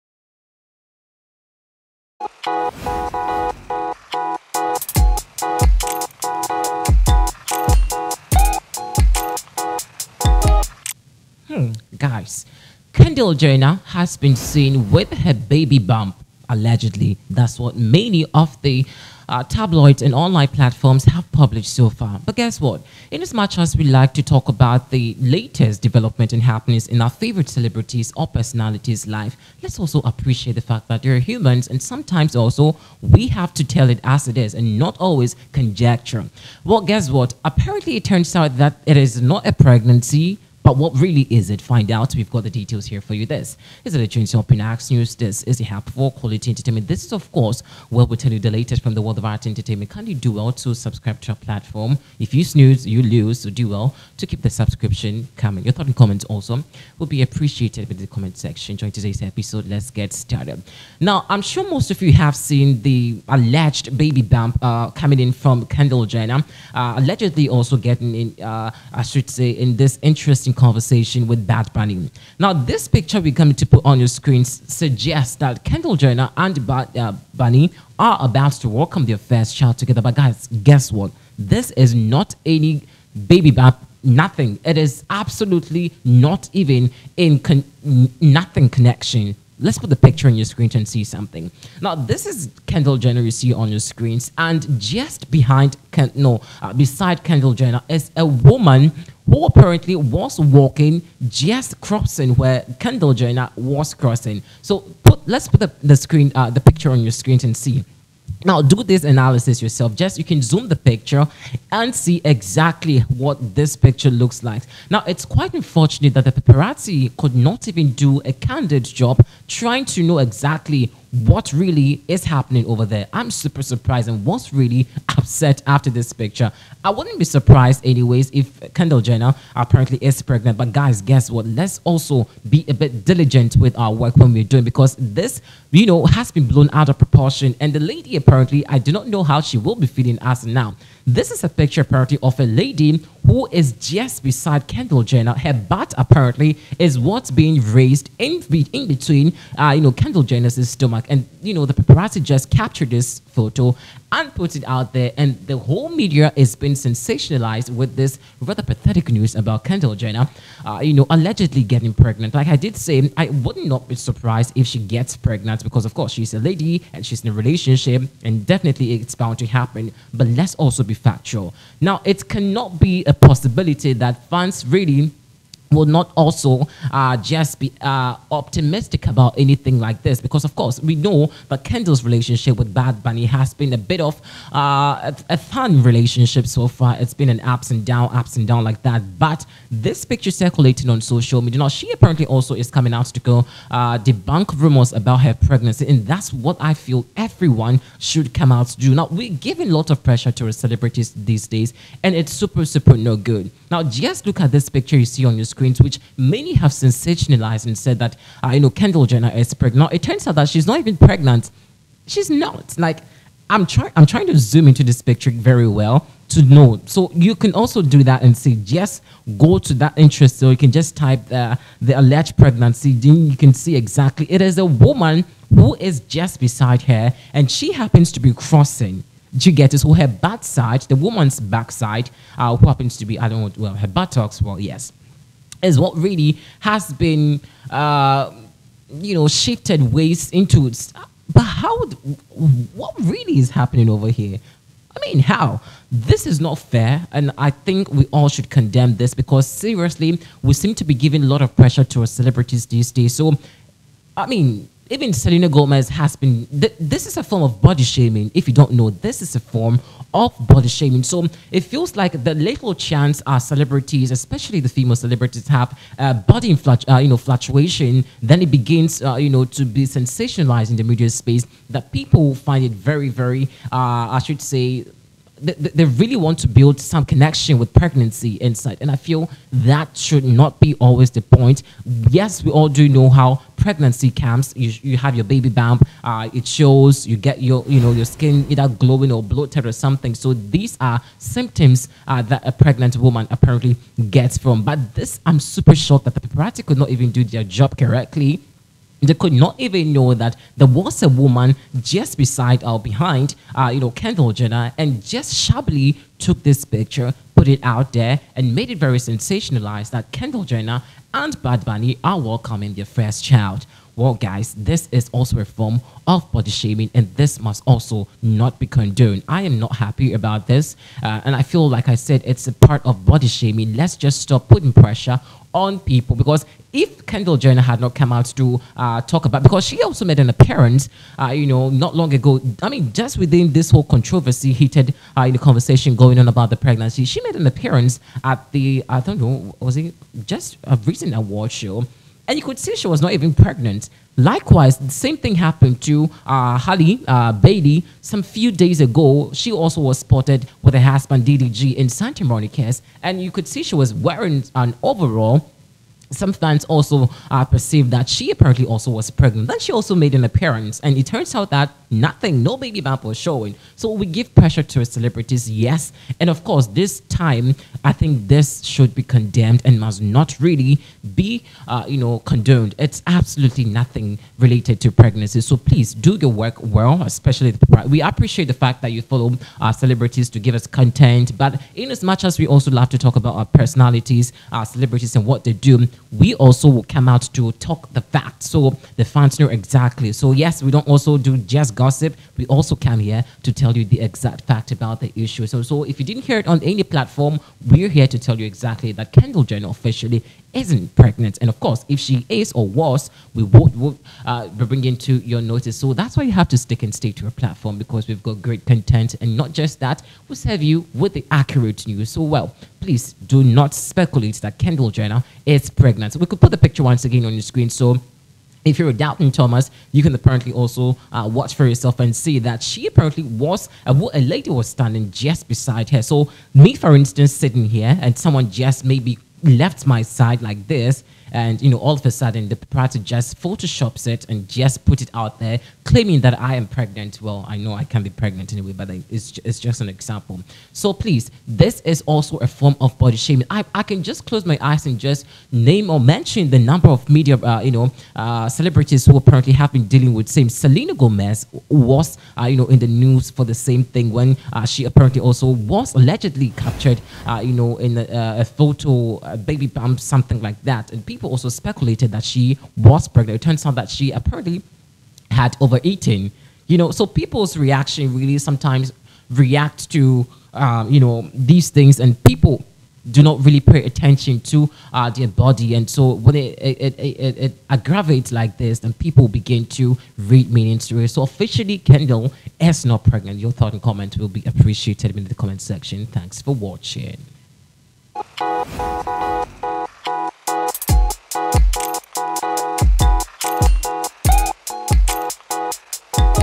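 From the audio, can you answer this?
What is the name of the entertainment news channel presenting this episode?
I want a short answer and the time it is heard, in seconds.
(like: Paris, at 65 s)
Trinity Pinax News, at 44 s.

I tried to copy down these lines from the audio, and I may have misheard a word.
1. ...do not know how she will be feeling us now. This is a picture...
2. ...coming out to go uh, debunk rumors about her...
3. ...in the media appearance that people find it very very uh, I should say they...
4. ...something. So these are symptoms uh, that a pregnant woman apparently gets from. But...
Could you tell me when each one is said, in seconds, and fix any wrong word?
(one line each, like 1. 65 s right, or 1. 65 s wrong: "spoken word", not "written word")
1. 138 s right
2. 192 s right
3. 270 s wrong: "space", not "appearance"
4. 289 s right.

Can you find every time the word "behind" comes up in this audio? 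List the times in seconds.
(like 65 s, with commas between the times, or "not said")
95 s, 302 s.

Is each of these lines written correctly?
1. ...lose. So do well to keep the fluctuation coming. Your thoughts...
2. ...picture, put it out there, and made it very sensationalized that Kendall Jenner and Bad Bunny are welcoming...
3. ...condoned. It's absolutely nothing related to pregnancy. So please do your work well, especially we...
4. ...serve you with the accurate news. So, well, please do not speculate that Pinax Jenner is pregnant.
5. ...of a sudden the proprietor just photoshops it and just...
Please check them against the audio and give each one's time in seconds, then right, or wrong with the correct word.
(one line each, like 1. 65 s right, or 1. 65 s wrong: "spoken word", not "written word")
1. 53 s wrong: "subscription", not "fluctuation"
2. 306 s right
3. 372 s right
4. 410 s wrong: "Kendall", not "Pinax"
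5. 431 s right.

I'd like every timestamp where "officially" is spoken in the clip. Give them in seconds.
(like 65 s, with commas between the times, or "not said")
399 s, 481 s.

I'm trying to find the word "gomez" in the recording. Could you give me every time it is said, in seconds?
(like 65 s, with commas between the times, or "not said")
255 s, 450 s.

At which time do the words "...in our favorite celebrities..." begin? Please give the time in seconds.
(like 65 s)
26 s.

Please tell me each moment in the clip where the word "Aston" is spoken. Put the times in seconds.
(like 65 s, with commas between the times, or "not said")
not said.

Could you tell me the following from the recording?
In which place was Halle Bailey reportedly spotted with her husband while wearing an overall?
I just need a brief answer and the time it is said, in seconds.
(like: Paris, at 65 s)
Santa Monica, at 351 s.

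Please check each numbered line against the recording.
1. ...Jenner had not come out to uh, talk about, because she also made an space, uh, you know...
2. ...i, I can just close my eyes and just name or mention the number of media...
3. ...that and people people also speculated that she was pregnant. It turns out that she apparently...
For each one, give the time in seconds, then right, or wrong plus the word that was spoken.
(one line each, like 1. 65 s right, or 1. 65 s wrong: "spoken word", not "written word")
1. 327 s wrong: "appearance", not "space"
2. 443 s right
3. 460 s right.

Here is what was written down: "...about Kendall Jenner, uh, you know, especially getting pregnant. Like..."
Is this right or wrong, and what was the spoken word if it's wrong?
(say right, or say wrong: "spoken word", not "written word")
wrong: "allegedly", not "especially".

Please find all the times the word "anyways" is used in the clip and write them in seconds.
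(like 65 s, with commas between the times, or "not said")
127 s, 438 s.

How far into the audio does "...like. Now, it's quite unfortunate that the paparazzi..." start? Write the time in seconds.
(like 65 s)
114 s.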